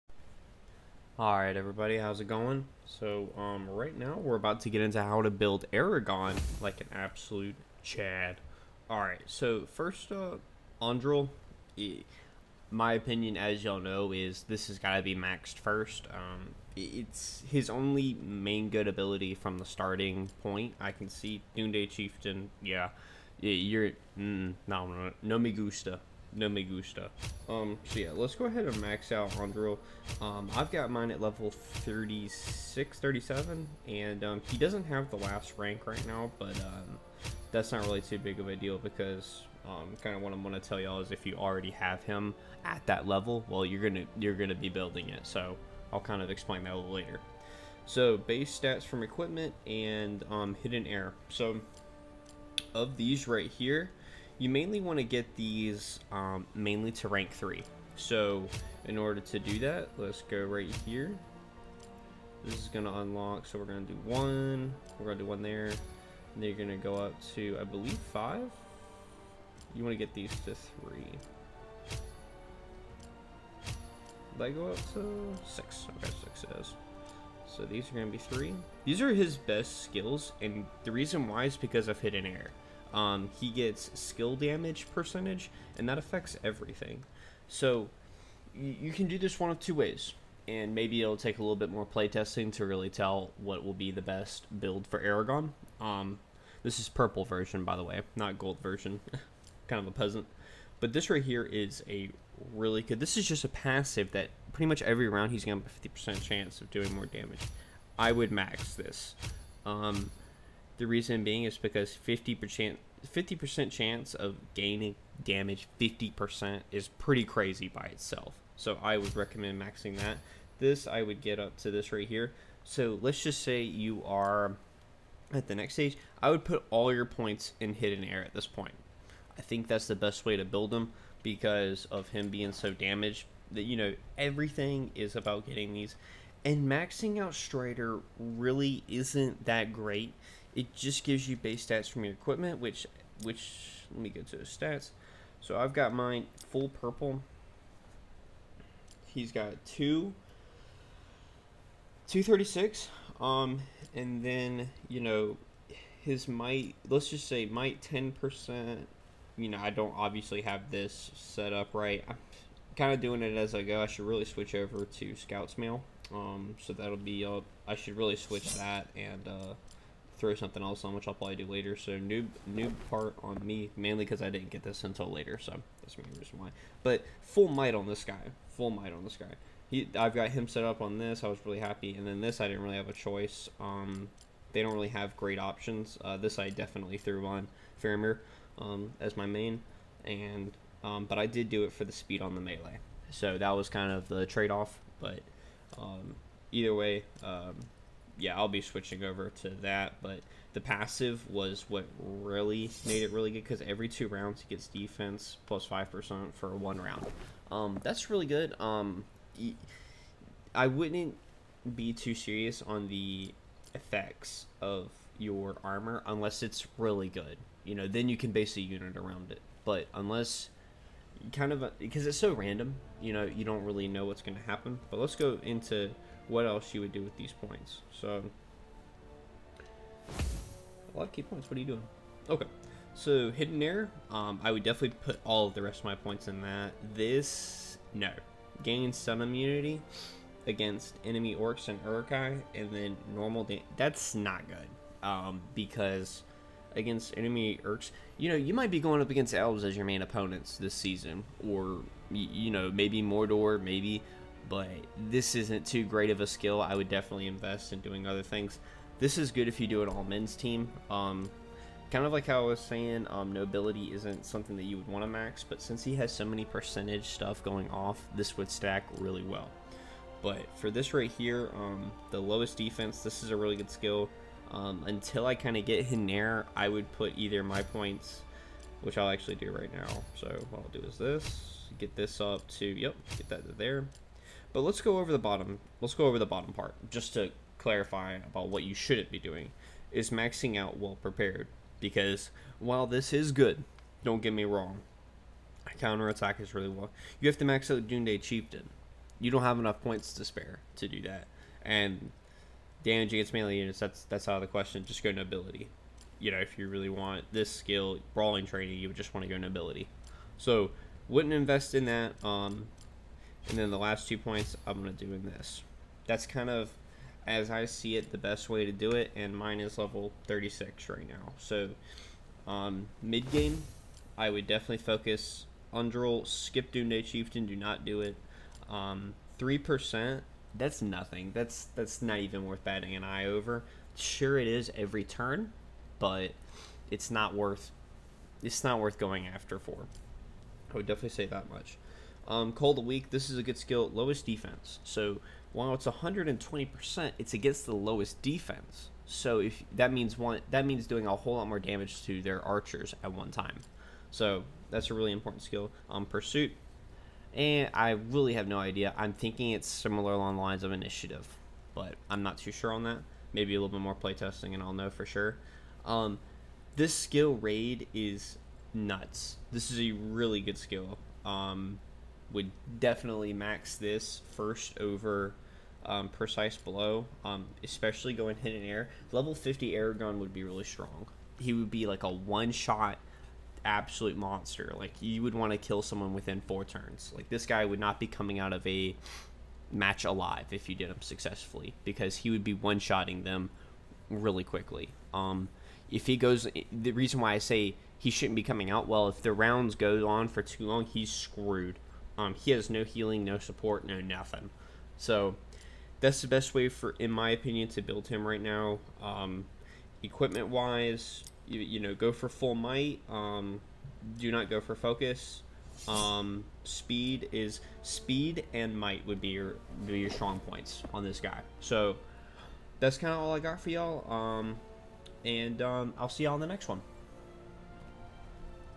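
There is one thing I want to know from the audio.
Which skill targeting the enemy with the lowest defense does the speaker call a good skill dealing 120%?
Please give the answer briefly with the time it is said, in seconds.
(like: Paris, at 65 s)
Cull the Weak, at 342 s.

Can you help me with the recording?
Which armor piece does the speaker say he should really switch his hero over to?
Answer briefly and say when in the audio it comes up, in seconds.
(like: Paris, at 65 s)
Scout's Mail, at 165 s.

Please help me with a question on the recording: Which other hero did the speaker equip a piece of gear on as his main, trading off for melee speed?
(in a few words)
Faramir.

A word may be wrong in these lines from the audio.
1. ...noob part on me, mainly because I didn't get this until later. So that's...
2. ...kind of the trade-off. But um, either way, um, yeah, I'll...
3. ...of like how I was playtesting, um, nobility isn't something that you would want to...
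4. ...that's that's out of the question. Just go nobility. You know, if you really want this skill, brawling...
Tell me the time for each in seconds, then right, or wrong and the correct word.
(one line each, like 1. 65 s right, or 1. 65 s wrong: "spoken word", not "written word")
1. 172 s right
2. 193 s right
3. 262 s wrong: "saying", not "playtesting"
4. 303 s right.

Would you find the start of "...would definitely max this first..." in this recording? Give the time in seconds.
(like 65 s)
372 s.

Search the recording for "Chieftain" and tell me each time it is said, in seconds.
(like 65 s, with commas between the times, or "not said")
21 s, 298 s, 327 s.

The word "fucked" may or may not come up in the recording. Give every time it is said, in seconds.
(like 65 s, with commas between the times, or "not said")
not said.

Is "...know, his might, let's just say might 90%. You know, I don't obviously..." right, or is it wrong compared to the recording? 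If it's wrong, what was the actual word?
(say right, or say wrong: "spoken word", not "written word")
wrong: "10", not "90".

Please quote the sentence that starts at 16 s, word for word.
Um, it's his only main good ability from the starting point.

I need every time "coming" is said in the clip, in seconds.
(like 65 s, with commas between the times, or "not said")
388 s, 398 s.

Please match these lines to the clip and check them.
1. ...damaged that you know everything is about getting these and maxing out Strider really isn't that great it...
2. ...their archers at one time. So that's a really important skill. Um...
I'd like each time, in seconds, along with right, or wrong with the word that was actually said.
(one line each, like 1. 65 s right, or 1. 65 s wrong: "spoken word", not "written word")
1. 132 s right
2. 352 s right.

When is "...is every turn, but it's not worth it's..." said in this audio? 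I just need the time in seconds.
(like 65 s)
334 s.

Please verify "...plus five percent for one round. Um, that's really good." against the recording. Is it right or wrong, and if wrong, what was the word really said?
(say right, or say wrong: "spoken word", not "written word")
right.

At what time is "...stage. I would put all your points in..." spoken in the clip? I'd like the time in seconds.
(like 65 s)
125 s.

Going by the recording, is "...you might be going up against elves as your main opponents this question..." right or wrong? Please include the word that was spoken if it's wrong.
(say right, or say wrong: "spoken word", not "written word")
wrong: "season", not "question".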